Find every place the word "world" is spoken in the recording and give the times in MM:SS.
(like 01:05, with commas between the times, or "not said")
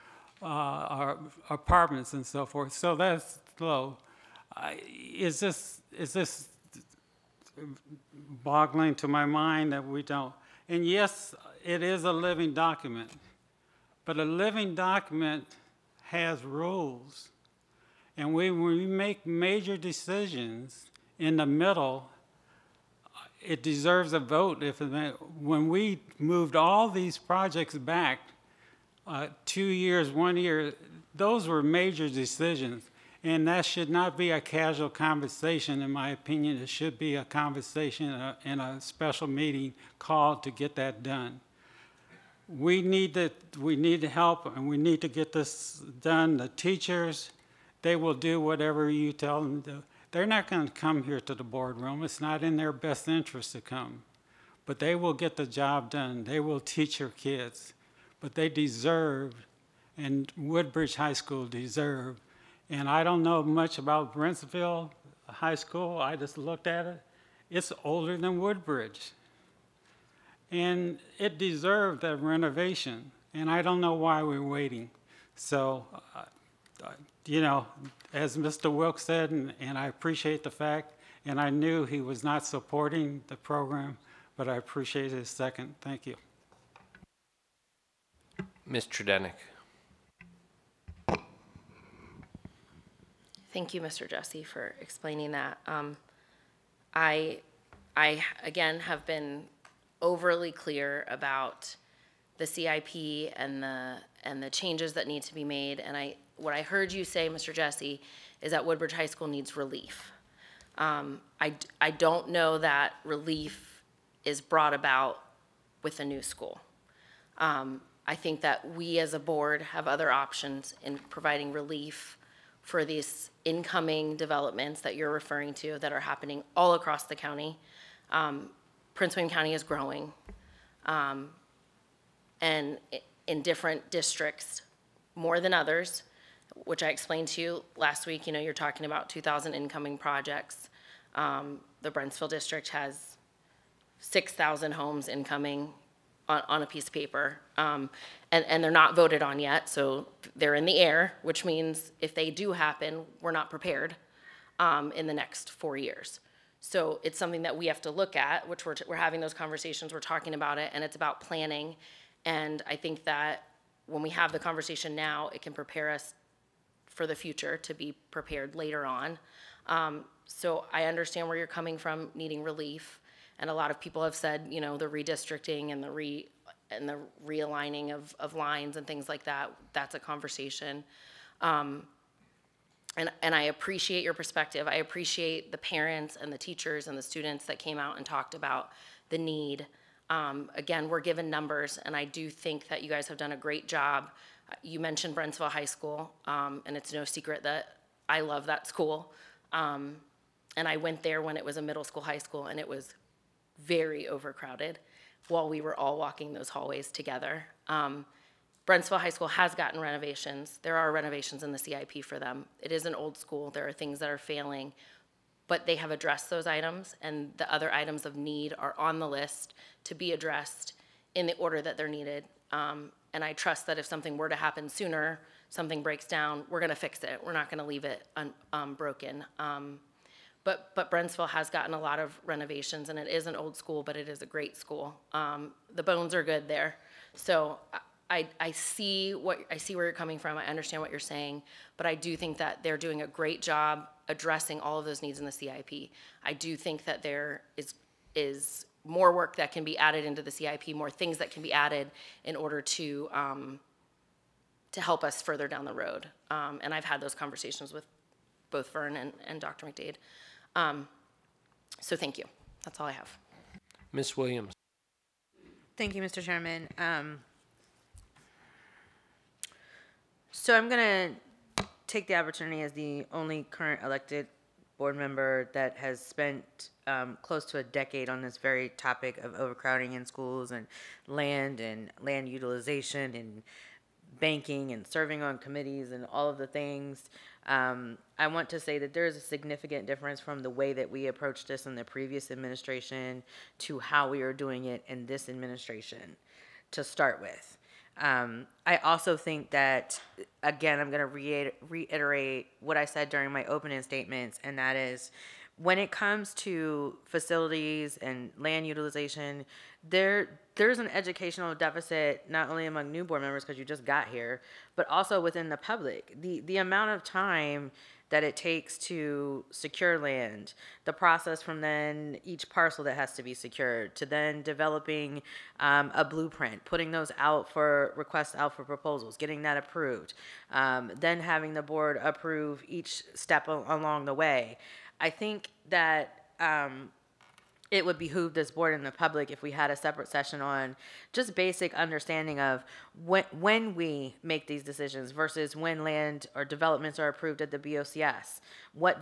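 not said.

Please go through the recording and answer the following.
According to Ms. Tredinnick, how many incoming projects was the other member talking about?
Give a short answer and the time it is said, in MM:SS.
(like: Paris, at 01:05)
2,000, at 02:19.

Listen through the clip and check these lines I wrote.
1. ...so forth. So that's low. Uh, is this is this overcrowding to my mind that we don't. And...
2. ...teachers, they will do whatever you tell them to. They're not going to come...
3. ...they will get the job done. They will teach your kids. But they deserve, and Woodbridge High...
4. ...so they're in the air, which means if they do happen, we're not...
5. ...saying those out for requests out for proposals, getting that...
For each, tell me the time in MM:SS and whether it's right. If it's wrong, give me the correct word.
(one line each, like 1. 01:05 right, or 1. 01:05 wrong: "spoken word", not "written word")
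1. 00:02 wrong: "boggling", not "overcrowding"
2. 00:46 right
3. 00:54 right
4. 02:29 right
5. 05:26 wrong: "putting", not "saying".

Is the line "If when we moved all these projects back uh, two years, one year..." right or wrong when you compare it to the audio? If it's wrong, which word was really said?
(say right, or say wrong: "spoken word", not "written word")
right.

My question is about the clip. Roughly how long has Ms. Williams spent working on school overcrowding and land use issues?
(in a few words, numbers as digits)
close to a decade.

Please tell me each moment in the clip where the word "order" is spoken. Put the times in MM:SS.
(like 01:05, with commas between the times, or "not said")
03:41, 04:12.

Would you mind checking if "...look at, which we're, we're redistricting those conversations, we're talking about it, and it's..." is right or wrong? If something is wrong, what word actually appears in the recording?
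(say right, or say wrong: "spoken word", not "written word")
wrong: "having", not "redistricting".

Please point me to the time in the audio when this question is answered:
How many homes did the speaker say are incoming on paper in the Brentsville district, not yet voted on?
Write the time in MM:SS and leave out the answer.
02:23.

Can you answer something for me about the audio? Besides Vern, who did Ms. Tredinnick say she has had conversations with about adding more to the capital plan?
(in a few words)
Dr. McDade.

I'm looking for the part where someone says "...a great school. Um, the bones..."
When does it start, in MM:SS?
03:54.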